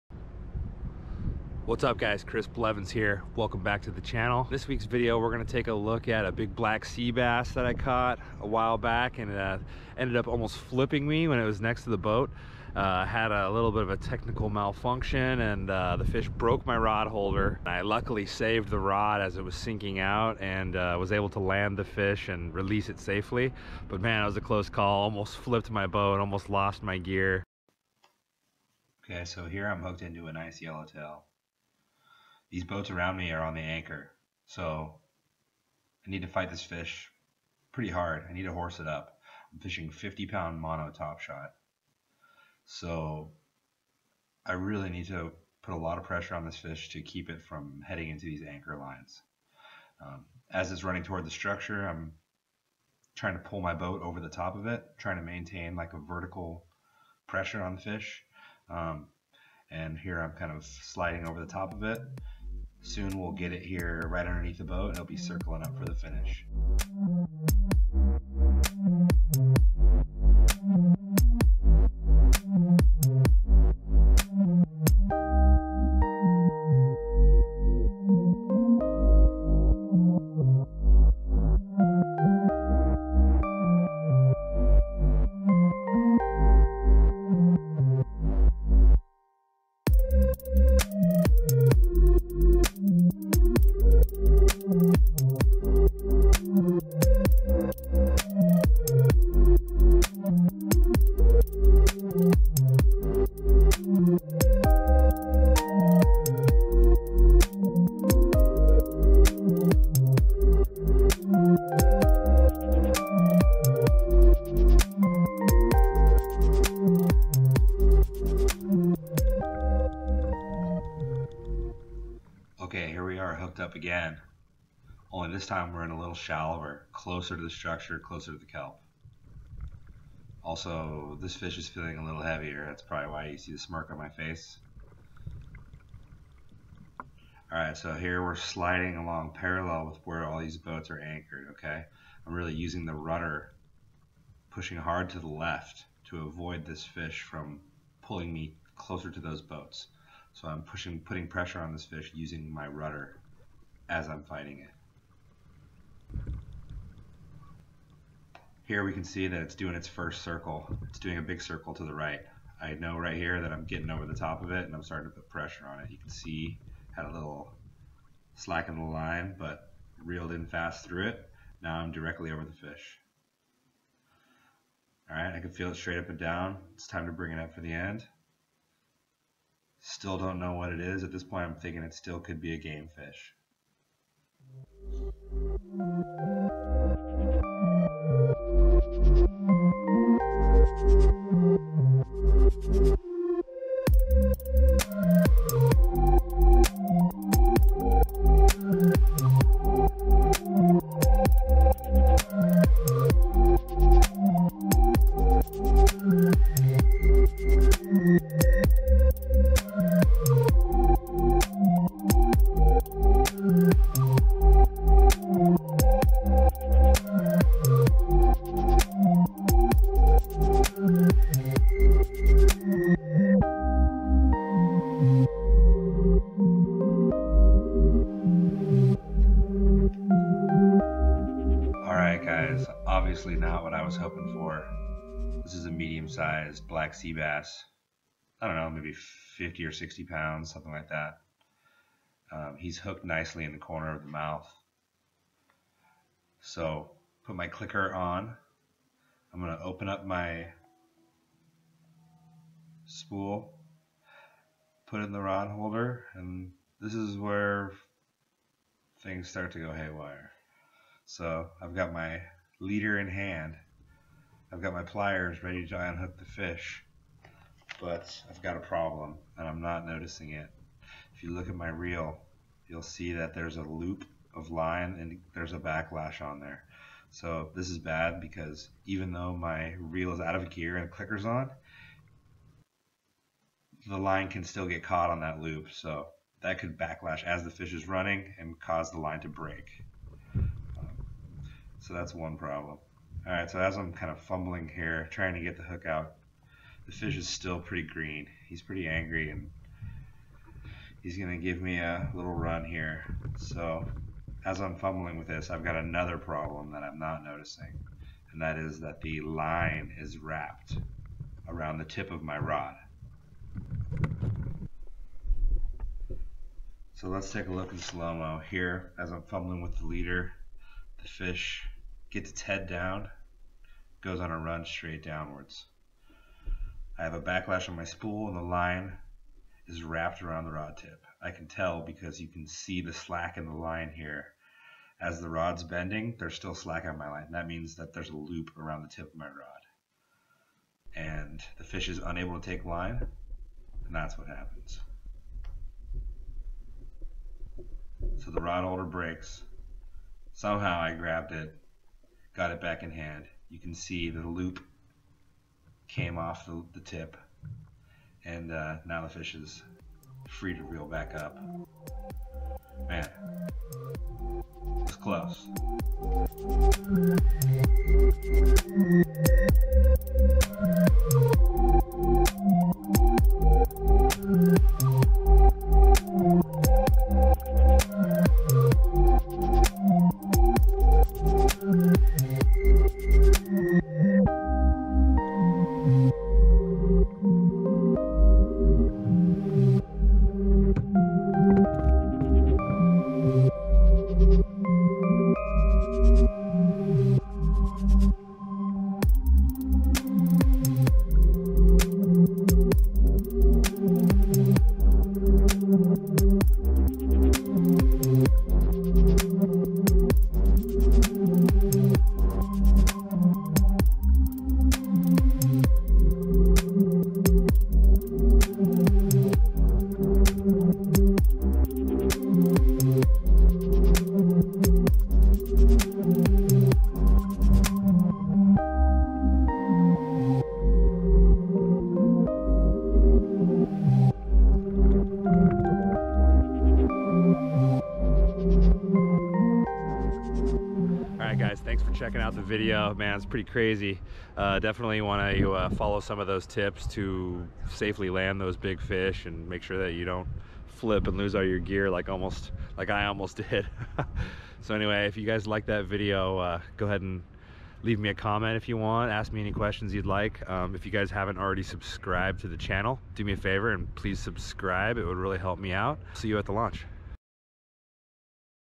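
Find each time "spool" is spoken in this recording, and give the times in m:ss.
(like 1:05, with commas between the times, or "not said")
4:12, 5:27.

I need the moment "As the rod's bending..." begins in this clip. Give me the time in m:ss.
5:34.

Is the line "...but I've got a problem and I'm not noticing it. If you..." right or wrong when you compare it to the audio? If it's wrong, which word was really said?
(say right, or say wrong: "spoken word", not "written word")
right.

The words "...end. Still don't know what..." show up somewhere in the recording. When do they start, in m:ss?
2:57.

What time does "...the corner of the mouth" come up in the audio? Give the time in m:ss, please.
4:03.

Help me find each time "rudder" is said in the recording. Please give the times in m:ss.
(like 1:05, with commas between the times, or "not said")
2:22, 2:32.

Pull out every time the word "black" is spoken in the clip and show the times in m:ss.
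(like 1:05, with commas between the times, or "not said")
0:06, 3:56.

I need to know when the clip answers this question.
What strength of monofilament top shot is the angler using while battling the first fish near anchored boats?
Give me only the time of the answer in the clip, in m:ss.
0:39.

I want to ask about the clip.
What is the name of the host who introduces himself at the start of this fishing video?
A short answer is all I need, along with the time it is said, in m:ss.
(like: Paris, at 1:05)
Chris Blevins, at 0:02.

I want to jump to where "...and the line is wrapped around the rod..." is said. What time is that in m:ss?
5:28.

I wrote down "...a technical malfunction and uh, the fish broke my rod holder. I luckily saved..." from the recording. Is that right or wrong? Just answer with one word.
right.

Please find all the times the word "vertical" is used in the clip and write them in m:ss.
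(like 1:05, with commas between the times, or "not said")
0:55.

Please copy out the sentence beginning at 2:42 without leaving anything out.
I know right here that I'm getting over the top of it and I'm starting to put pressure on it.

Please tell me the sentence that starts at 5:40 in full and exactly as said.
And the fish is unable to take line, and that's what happens.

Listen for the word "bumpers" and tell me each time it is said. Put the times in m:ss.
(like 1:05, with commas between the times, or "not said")
not said.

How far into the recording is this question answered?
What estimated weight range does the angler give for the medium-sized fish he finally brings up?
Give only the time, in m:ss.
3:59.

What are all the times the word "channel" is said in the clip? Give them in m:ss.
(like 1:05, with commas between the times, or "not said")
0:04, 7:42.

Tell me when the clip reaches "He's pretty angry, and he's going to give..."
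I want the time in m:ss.
4:58.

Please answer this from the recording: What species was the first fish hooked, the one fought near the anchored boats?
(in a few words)
yellowtail.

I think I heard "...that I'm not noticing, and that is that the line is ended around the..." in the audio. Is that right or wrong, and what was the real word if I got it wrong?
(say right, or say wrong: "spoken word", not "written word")
wrong: "wrapped", not "ended".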